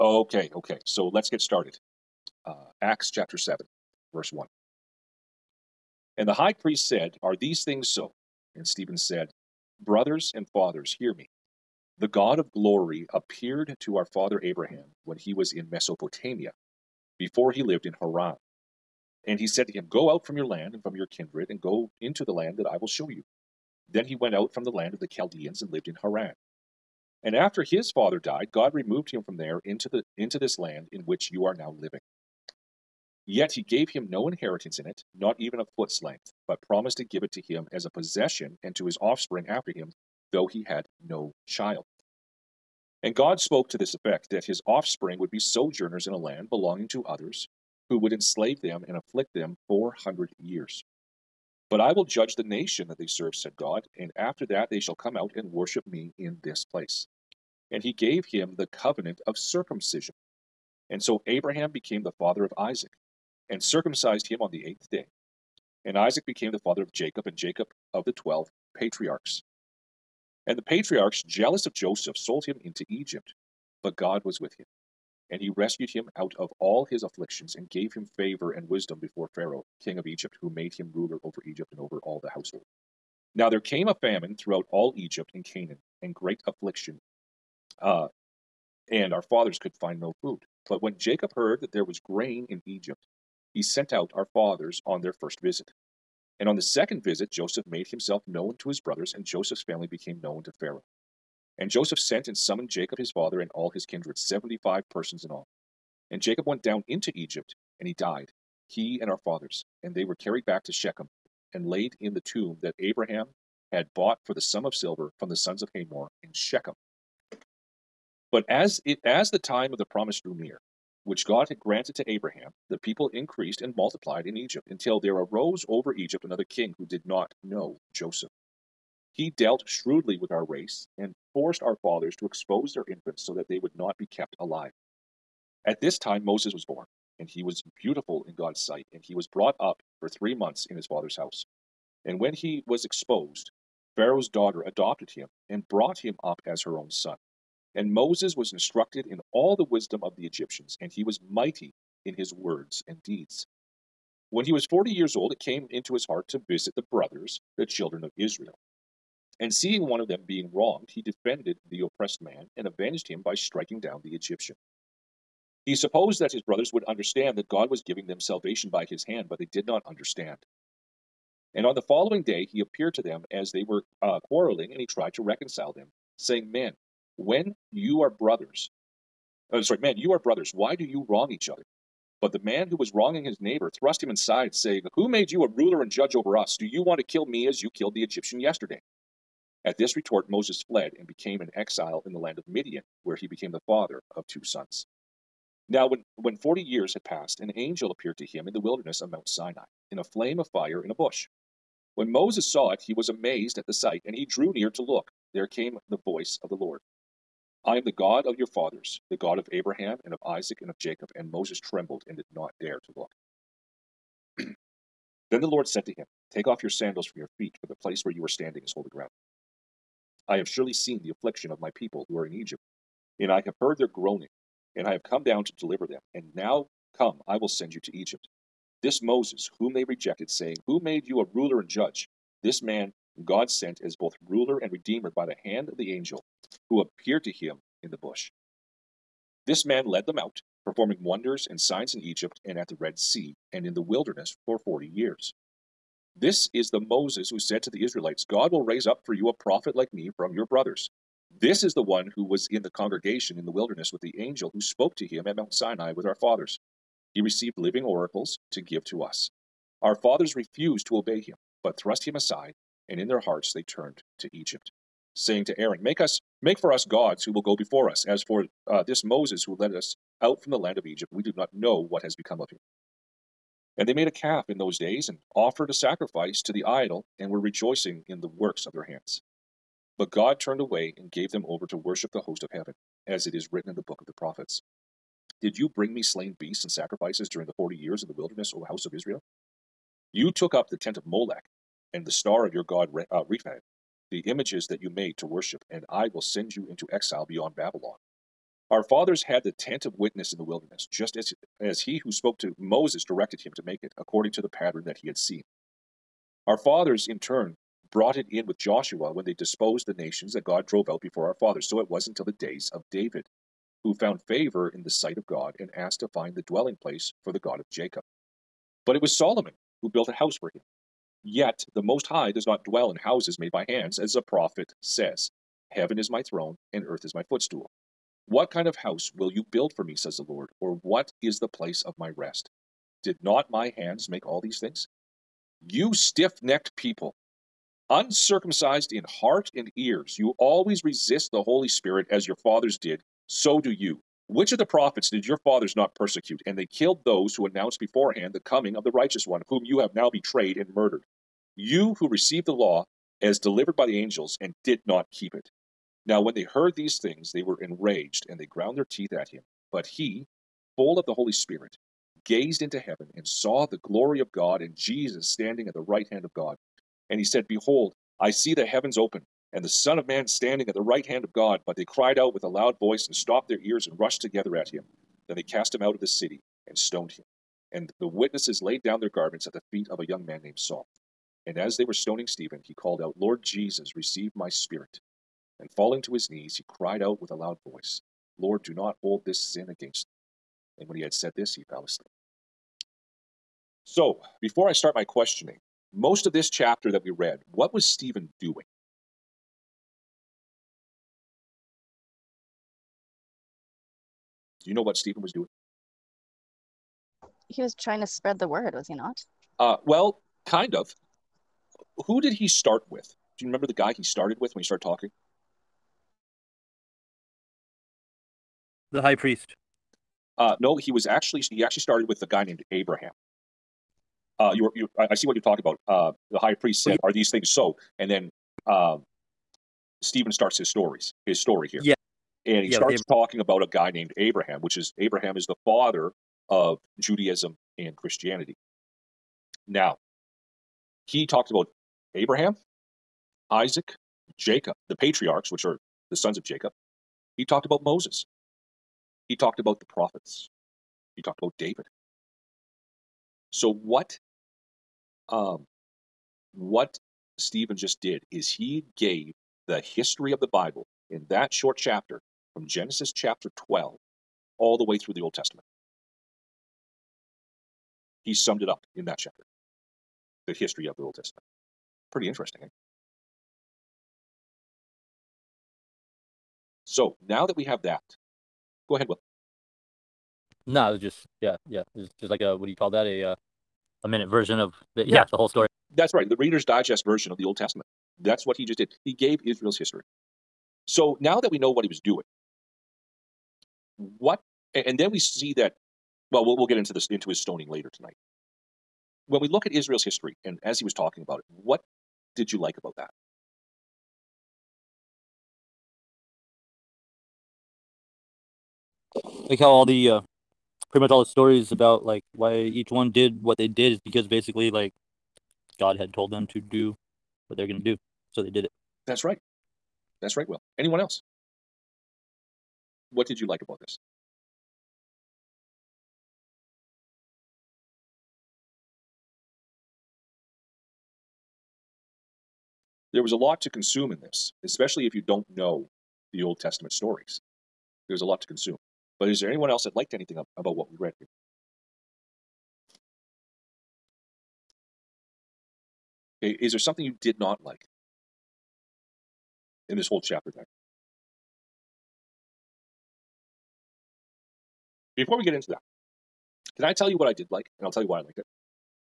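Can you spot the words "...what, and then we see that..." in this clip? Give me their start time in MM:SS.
08:13.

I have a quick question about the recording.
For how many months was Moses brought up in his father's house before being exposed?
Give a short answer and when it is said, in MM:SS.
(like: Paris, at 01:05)
3, at 02:20.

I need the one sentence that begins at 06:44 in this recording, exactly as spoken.
Do you know what Stephen was doing?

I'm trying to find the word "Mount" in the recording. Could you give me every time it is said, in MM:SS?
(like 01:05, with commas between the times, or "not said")
03:19, 04:15.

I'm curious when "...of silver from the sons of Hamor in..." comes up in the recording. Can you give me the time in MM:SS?
01:54.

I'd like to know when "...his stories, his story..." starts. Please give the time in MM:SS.
07:10.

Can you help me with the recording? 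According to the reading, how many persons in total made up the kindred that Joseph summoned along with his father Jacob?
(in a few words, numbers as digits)
75.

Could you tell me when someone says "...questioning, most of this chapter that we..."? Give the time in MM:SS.
06:35.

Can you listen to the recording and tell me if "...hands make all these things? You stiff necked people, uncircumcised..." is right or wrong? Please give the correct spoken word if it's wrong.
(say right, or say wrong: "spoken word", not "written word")
right.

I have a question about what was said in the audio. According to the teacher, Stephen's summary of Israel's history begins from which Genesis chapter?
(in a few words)
Chapter 12.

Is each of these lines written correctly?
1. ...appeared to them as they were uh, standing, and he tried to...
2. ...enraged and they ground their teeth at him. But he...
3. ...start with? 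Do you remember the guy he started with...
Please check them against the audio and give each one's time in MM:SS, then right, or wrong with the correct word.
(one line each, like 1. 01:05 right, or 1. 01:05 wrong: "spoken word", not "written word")
1. 02:52 wrong: "quarreling", not "standing"
2. 05:57 right
3. 06:52 right.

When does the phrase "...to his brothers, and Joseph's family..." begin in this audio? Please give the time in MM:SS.
01:38.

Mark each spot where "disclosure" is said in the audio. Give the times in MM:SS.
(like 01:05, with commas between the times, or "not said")
not said.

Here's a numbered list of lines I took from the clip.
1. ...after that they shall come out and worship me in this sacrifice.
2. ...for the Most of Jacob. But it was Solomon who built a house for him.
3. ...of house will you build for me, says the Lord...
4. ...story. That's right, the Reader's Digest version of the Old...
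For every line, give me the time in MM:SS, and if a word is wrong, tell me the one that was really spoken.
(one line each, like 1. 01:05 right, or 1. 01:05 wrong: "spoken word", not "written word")
1. 00:54 wrong: "place", not "sacrifice"
2. 05:17 wrong: "God", not "Most"
3. 05:28 right
4. 08:05 right.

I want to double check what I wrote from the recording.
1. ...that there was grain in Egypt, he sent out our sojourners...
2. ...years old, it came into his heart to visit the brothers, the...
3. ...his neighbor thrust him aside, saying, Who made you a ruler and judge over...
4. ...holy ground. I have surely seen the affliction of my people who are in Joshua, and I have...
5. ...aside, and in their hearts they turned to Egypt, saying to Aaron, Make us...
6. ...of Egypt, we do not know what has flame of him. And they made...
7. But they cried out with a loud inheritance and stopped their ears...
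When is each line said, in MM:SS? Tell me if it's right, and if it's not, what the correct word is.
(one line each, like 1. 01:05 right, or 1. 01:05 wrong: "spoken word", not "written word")
1. 01:31 wrong: "fathers", not "sojourners"
2. 02:34 right
3. 03:03 right
4. 03:38 wrong: "Egypt", not "Joshua"
5. 04:22 right
6. 04:30 wrong: "become", not "flame"
7. 06:11 wrong: "voice", not "inheritance".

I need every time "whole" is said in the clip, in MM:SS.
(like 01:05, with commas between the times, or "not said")
08:05, 09:10.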